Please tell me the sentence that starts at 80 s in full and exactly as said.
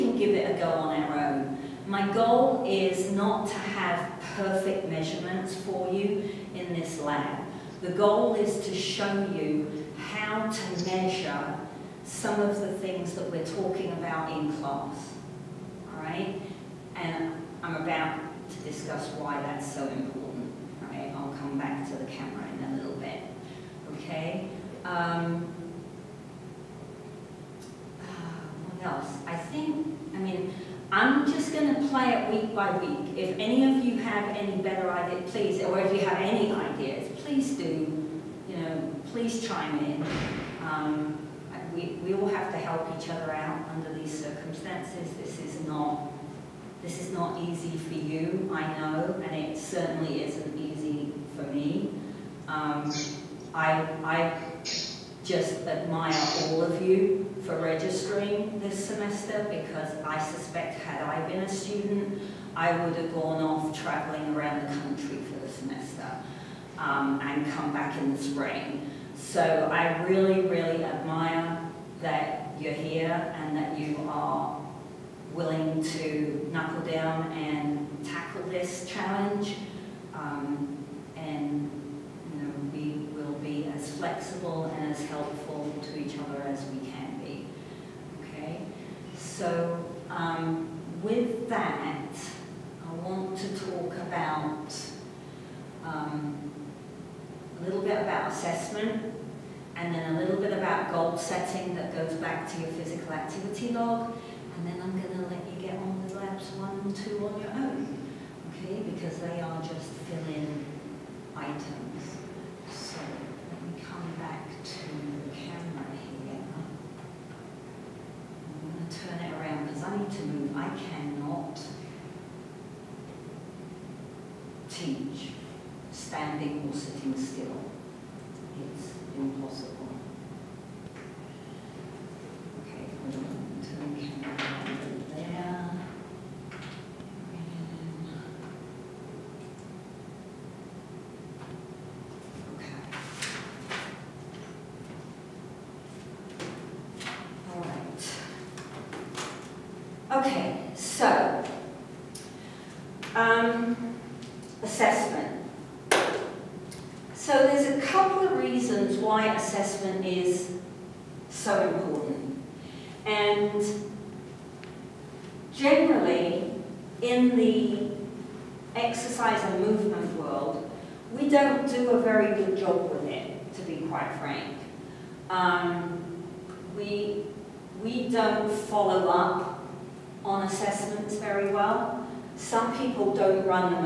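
Um, and you know, we will be as flexible and as helpful to each other as we can.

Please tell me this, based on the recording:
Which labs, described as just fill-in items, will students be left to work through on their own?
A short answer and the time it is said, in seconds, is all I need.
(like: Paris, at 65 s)
labs 1 and 2, at 106 s.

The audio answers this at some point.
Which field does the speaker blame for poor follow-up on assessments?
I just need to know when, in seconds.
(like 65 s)
169 s.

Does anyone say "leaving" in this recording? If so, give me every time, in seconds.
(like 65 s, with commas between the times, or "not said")
not said.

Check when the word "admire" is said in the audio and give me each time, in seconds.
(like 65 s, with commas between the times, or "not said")
55 s, 70 s.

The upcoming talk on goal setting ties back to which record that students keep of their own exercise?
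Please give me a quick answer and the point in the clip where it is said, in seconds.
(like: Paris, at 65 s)
physical activity log, at 102 s.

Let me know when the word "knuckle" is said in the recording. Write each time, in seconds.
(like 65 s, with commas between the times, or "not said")
76 s.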